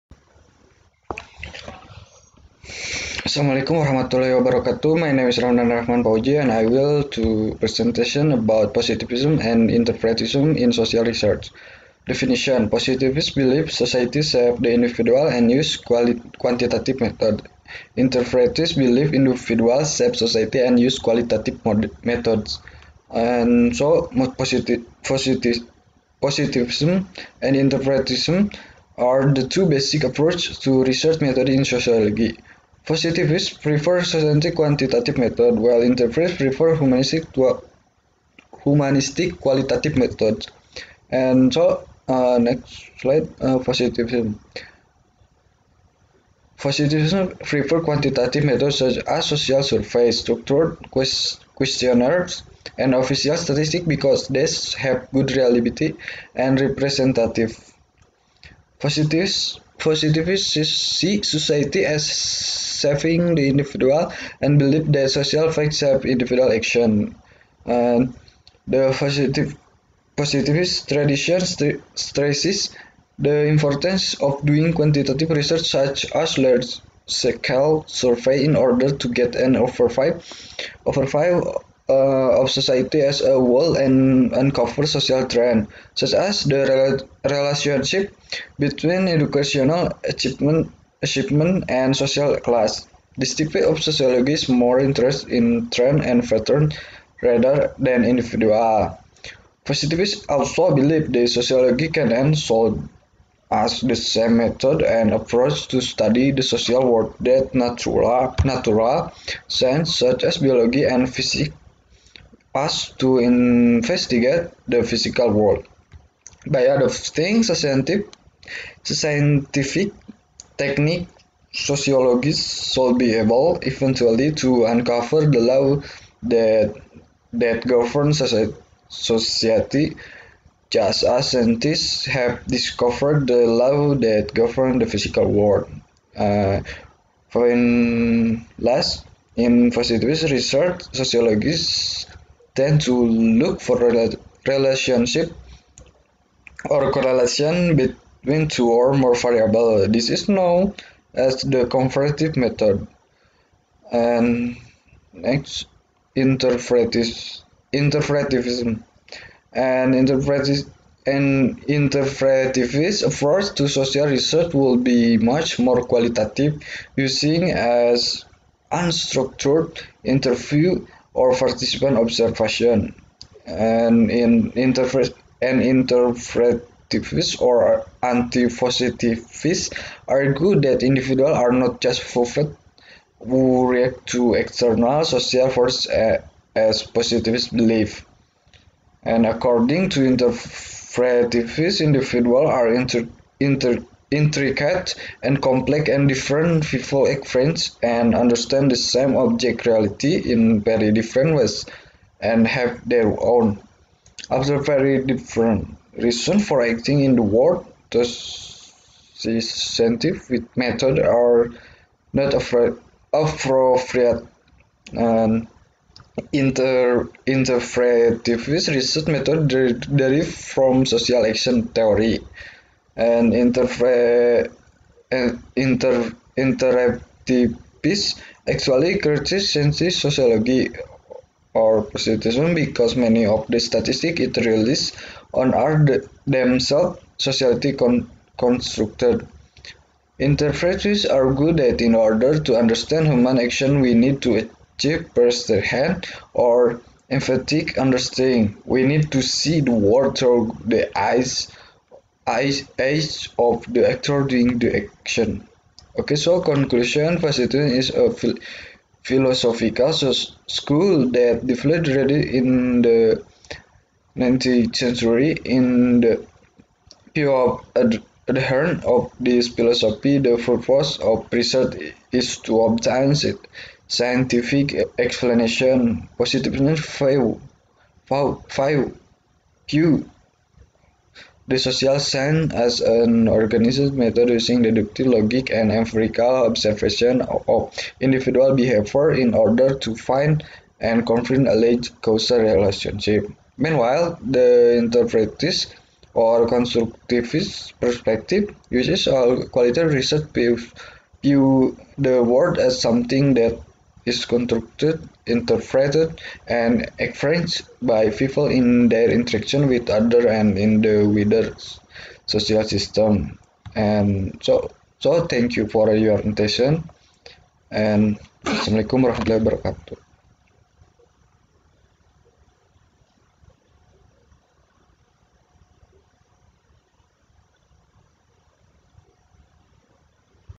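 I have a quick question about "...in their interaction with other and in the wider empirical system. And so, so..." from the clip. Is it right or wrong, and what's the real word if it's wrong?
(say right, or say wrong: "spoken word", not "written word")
wrong: "social", not "empirical".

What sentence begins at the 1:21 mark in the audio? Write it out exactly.
uh, of society as a whole and uncover social trend, such as the relationship between educational achievement, achievement and social class.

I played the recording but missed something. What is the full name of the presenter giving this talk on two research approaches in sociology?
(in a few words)
Ramdan Rahman Fauzi.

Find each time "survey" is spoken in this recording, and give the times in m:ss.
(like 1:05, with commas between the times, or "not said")
0:49, 1:17.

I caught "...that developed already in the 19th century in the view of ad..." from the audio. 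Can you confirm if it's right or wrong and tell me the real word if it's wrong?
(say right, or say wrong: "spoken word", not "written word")
right.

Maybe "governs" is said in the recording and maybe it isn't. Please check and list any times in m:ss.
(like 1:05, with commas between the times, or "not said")
2:07, 2:14.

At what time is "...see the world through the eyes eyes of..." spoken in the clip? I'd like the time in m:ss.
4:09.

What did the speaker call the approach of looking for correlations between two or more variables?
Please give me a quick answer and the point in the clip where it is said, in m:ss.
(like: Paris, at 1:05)
comparative method, at 2:31.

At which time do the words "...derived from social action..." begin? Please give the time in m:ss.
3:39.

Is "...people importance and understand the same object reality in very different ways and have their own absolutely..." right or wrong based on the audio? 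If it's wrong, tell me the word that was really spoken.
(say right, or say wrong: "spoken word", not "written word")
wrong: "experience", not "importance".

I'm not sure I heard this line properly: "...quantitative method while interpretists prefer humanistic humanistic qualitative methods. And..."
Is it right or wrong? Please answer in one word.
right.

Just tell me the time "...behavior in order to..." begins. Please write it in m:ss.
4:48.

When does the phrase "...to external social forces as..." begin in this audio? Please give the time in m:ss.
3:04.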